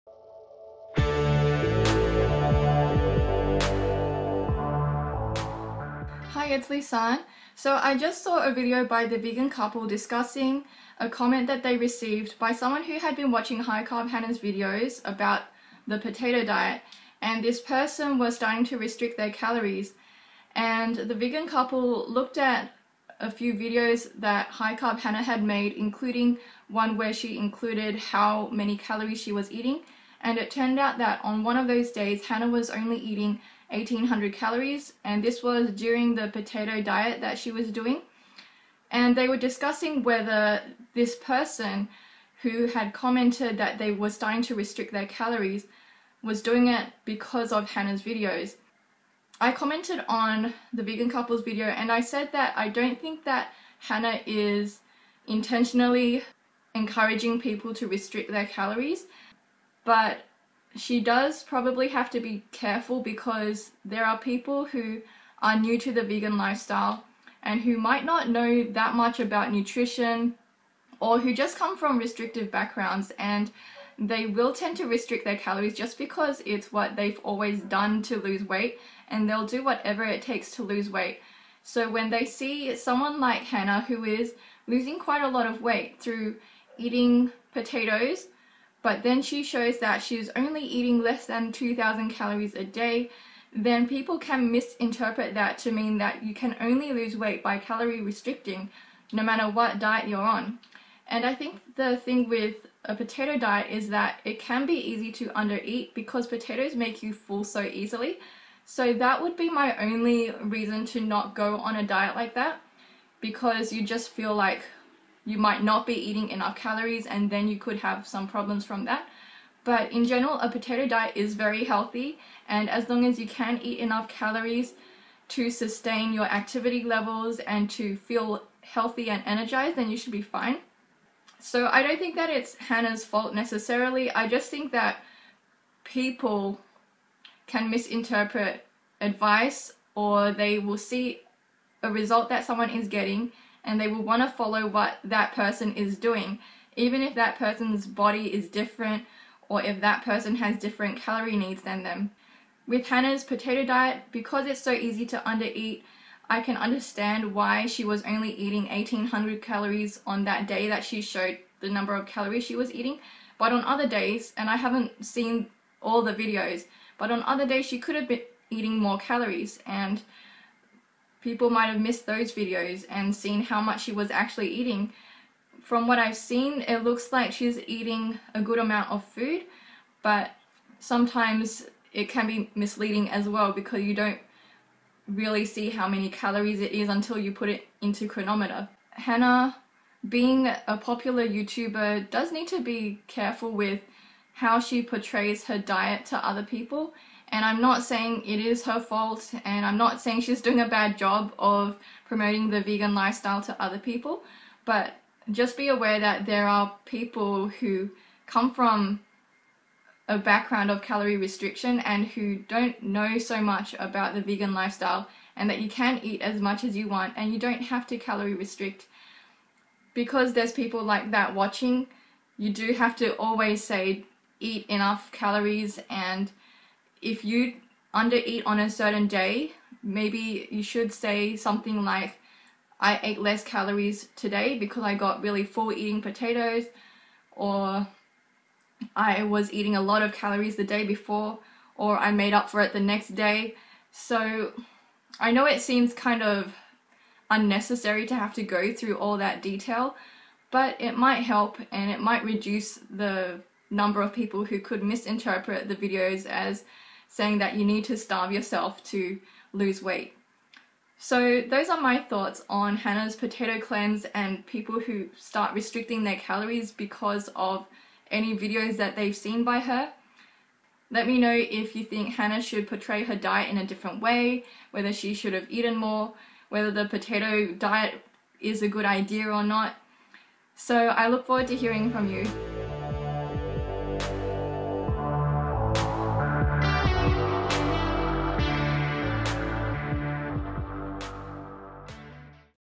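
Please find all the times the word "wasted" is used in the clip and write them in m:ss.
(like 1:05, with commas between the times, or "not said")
not said.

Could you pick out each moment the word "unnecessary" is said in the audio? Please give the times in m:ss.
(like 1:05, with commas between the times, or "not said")
4:07.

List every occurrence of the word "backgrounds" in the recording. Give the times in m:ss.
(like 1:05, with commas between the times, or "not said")
1:12, 3:30.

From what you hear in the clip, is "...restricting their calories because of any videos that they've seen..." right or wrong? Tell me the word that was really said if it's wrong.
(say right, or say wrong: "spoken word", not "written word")
right.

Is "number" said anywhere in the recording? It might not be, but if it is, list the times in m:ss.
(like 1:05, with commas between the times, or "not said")
2:41, 4:13.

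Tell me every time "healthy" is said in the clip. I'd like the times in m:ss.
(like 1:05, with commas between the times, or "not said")
2:01, 2:08.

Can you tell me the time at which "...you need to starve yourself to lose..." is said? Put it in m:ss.
4:17.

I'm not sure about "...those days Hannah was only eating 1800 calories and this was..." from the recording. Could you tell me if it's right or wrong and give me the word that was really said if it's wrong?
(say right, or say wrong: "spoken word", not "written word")
right.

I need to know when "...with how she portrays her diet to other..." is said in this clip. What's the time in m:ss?
3:13.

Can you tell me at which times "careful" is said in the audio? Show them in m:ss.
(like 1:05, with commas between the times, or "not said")
1:02, 3:13.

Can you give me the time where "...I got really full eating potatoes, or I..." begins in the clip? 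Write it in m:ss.
3:54.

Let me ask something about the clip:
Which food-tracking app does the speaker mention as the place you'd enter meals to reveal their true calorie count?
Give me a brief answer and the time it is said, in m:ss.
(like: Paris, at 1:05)
Cronometer, at 3:08.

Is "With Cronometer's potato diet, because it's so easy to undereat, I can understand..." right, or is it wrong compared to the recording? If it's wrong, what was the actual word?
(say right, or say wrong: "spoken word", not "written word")
wrong: "Hannah", not "Cronometer".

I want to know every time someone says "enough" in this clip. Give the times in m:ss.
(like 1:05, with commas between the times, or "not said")
1:56, 2:03, 3:44.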